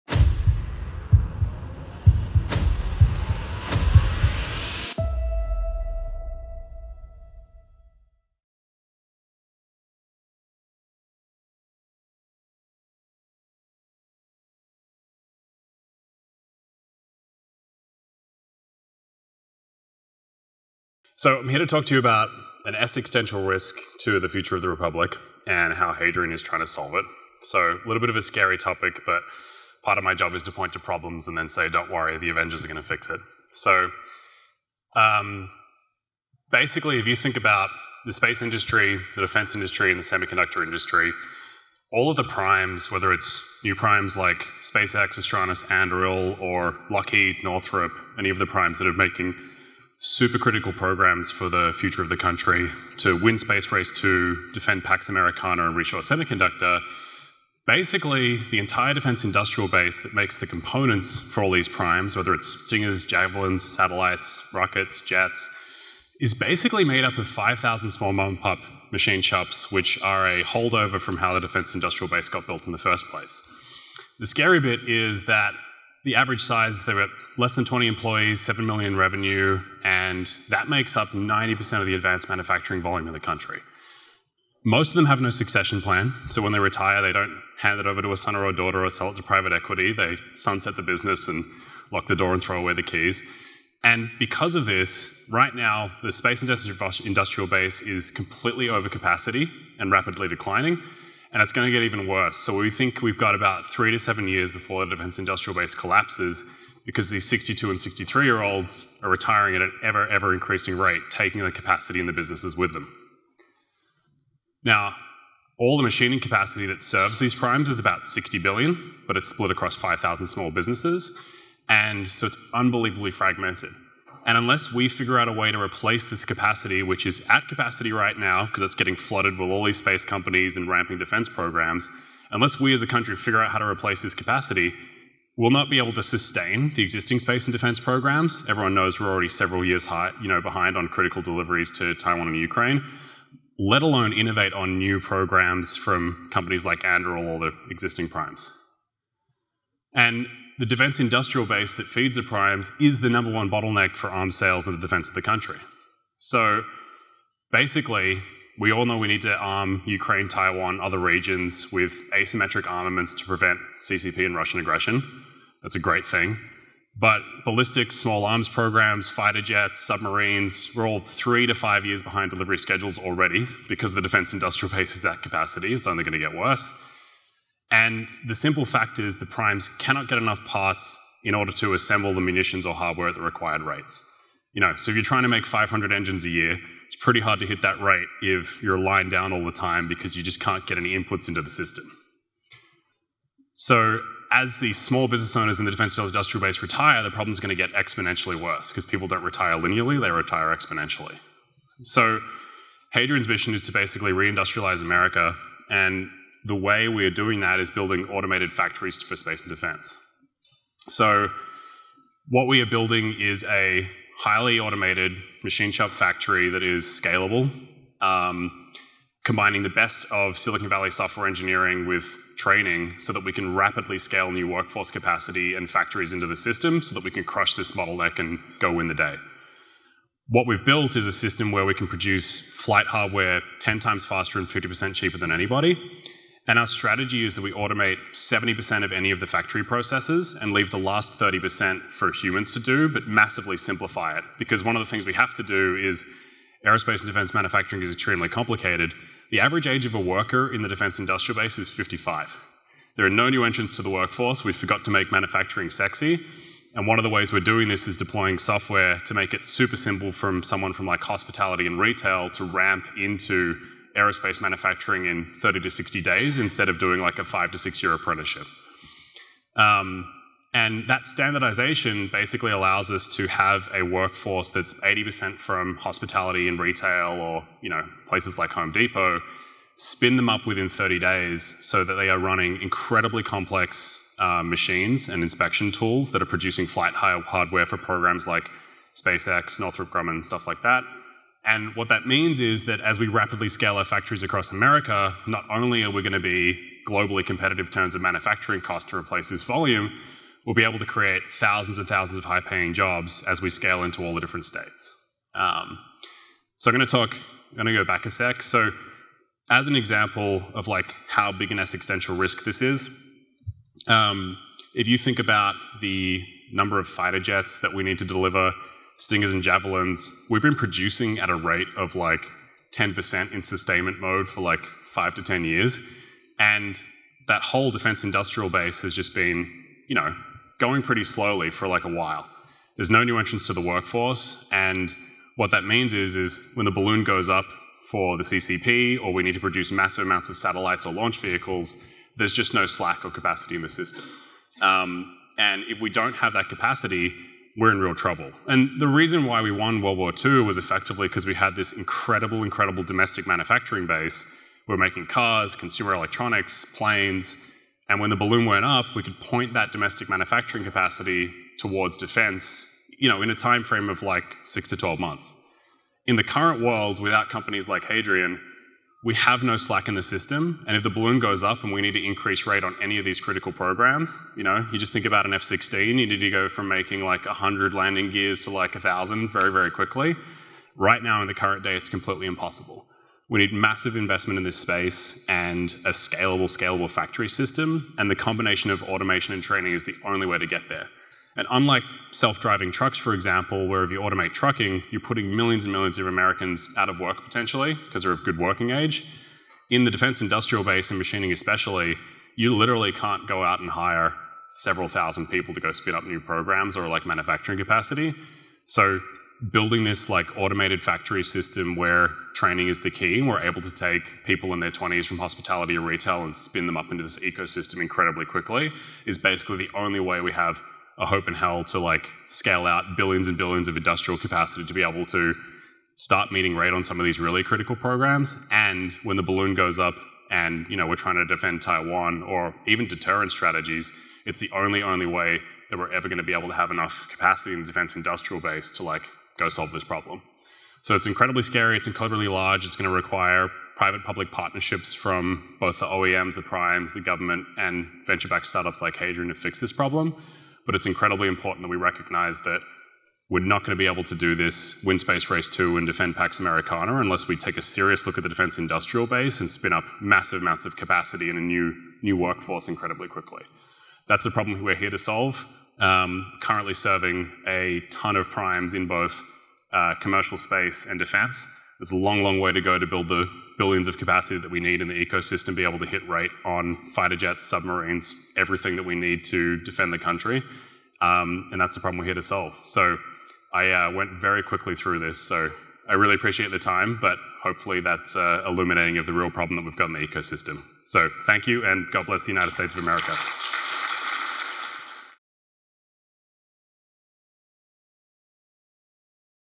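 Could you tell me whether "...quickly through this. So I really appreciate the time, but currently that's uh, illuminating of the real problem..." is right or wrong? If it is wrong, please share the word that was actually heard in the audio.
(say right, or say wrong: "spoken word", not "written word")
wrong: "hopefully", not "currently".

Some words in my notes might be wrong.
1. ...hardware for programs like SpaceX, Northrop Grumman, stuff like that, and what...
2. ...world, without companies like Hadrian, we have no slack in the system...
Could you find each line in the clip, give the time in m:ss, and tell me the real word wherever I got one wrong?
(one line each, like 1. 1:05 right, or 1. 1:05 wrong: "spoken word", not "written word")
1. 4:46 right
2. 6:06 right.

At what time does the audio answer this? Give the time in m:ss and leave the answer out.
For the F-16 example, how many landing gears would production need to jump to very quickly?
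6:18.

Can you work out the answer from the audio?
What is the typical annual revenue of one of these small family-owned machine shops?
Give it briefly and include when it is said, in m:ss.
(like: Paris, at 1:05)
7 million, at 1:18.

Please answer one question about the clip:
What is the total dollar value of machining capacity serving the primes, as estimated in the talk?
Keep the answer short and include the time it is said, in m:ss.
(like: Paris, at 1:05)
60 billion, at 1:57.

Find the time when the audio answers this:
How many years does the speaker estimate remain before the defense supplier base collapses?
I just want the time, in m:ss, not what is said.
1:43.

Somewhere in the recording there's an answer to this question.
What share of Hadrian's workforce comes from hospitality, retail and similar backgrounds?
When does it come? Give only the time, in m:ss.
4:34.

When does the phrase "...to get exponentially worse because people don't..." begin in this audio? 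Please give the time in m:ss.
3:17.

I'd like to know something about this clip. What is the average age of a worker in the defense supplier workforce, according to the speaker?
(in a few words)
55.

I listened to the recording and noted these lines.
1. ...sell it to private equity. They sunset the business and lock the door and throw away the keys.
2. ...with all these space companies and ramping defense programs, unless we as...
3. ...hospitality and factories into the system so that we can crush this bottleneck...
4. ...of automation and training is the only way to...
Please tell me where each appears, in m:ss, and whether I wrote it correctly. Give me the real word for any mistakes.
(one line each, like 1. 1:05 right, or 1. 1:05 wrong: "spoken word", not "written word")
1. 1:28 right
2. 2:09 right
3. 3:44 wrong: "capacity", not "hospitality"
4. 6:28 right.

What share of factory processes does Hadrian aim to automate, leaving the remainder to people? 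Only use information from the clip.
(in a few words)
70%.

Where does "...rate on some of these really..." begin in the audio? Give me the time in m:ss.
7:06.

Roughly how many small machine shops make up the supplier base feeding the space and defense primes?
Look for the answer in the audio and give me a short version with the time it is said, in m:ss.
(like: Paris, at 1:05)
5,000, at 1:07.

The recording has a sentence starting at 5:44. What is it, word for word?
Um, and if we don't have that capacity, we're in real trouble.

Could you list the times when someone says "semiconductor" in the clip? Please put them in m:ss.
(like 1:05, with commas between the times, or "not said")
0:40, 0:56.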